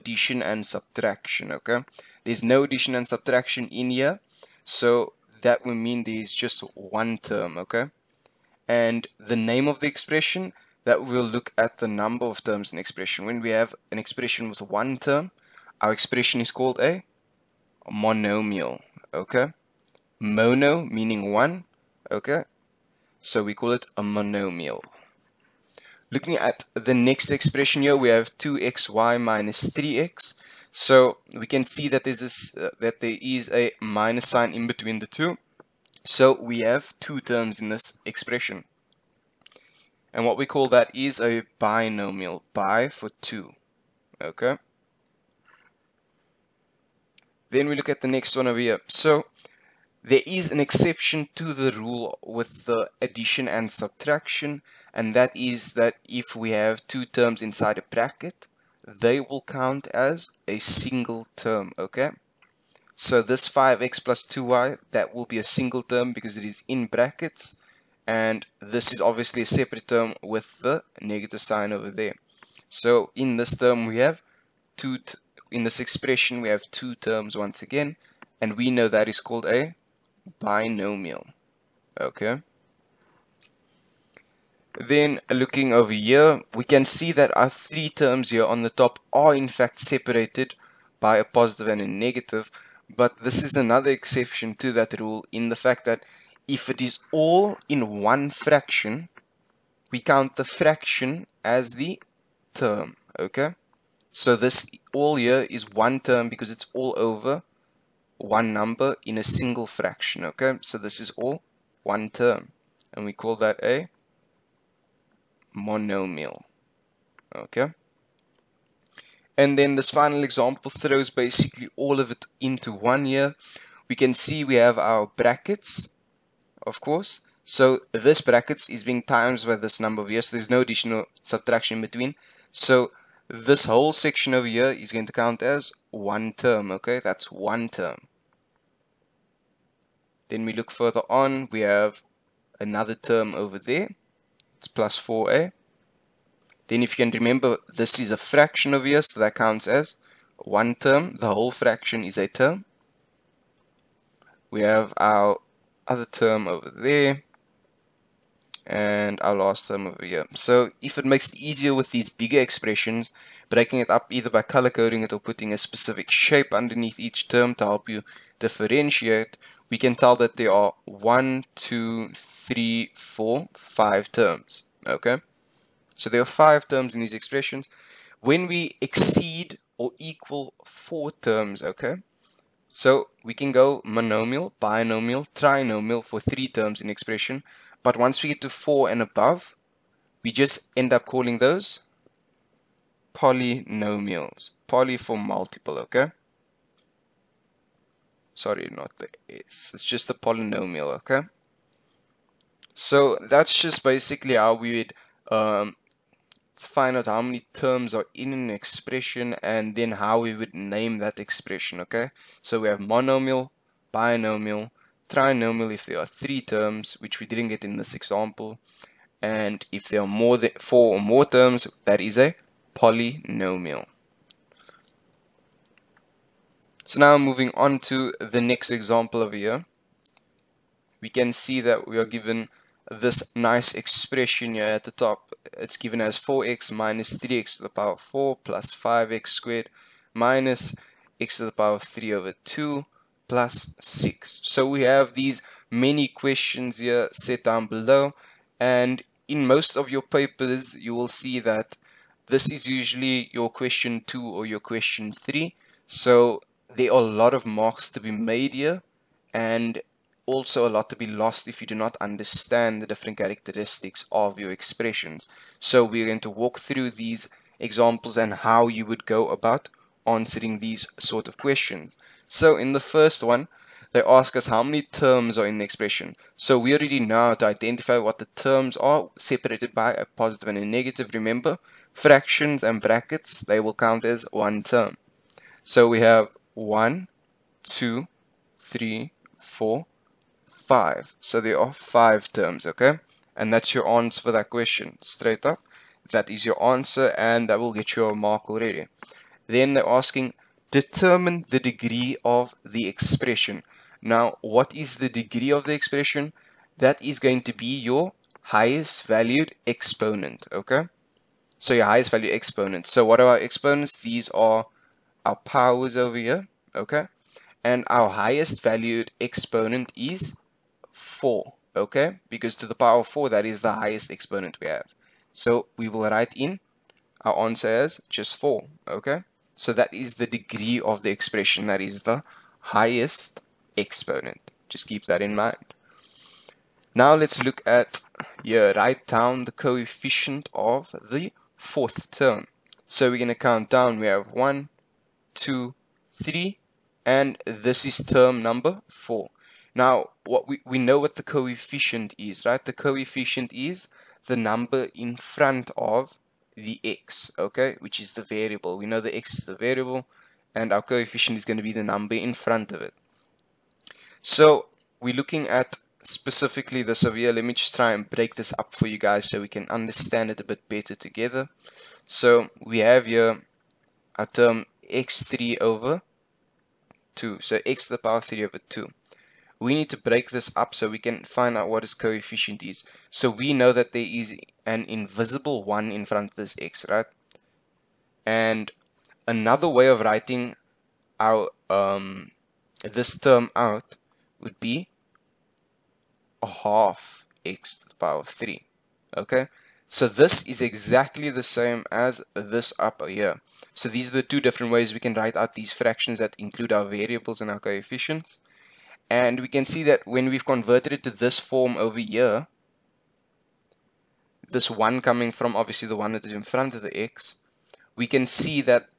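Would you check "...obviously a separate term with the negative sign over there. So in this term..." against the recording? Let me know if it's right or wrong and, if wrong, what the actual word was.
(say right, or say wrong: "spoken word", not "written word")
right.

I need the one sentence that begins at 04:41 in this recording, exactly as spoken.
Remember, fractions and brackets, they will count as one term.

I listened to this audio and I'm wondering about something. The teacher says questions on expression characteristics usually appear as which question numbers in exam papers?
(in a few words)
question 2 or 3.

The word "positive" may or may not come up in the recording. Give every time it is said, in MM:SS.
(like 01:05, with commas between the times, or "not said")
01:31, 04:40.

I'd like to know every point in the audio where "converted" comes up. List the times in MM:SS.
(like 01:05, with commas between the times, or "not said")
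06:50.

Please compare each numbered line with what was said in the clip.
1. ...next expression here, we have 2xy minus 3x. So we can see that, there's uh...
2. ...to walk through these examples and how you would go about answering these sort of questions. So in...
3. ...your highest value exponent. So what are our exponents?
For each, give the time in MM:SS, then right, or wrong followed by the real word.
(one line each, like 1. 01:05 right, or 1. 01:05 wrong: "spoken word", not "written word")
1. 00:26 right
2. 04:26 right
3. 05:11 right.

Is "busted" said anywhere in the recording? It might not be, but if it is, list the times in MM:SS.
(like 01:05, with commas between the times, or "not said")
not said.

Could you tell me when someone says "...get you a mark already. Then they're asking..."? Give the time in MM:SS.
04:57.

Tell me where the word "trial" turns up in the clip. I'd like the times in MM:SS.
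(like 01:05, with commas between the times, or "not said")
not said.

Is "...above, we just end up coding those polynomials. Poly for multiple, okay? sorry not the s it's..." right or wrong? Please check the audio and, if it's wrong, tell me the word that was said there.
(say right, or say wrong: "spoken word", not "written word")
wrong: "calling", not "coding".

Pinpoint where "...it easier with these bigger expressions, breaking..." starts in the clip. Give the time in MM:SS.
02:41.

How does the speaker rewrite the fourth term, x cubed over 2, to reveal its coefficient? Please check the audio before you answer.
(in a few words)
a half x to the power of 3.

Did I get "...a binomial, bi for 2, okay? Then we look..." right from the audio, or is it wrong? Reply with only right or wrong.
right.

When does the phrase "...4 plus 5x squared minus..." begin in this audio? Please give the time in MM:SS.
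03:57.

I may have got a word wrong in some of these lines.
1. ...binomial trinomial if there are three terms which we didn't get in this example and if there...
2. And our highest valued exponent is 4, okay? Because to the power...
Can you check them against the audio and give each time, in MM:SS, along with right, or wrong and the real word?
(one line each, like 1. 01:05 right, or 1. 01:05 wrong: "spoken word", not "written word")
1. 03:33 right
2. 05:17 right.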